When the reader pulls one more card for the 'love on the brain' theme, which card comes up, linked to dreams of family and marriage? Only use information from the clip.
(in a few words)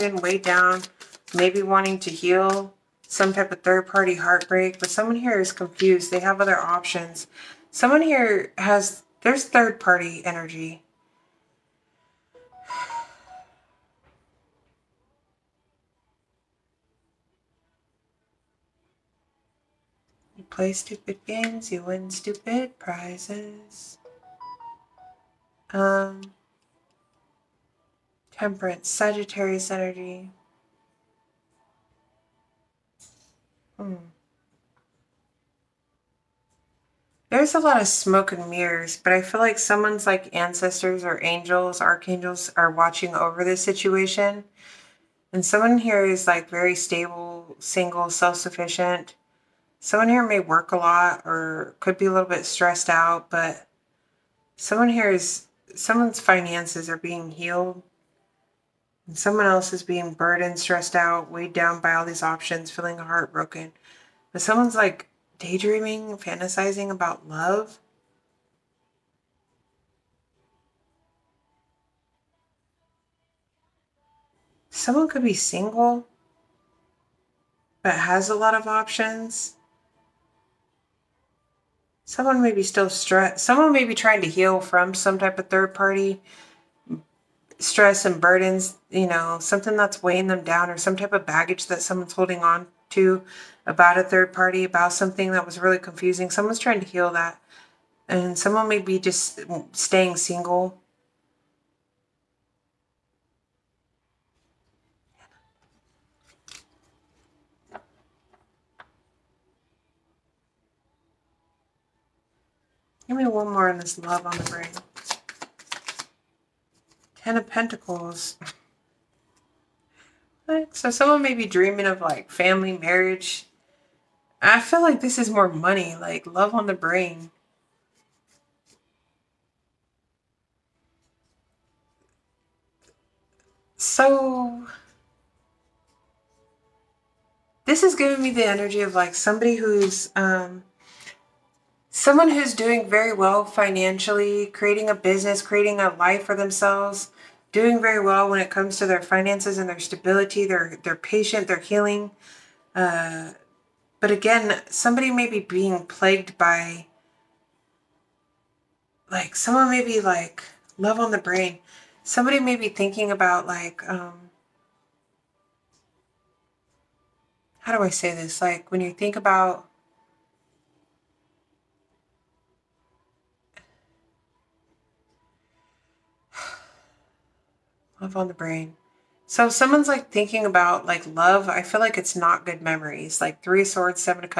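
Ten of Pentacles.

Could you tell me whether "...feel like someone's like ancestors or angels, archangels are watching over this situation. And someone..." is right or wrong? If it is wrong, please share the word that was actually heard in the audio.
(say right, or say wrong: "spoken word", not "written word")
right.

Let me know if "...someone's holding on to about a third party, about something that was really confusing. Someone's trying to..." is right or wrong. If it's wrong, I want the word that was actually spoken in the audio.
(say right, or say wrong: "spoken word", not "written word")
right.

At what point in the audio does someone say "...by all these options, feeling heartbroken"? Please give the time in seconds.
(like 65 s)
61 s.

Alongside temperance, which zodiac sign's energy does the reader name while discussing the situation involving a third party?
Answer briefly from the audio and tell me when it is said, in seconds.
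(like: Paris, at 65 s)
Sagittarius, at 28 s.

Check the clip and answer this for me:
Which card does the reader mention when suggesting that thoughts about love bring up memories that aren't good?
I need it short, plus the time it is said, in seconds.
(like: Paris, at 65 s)
Three of Swords, at 183 s.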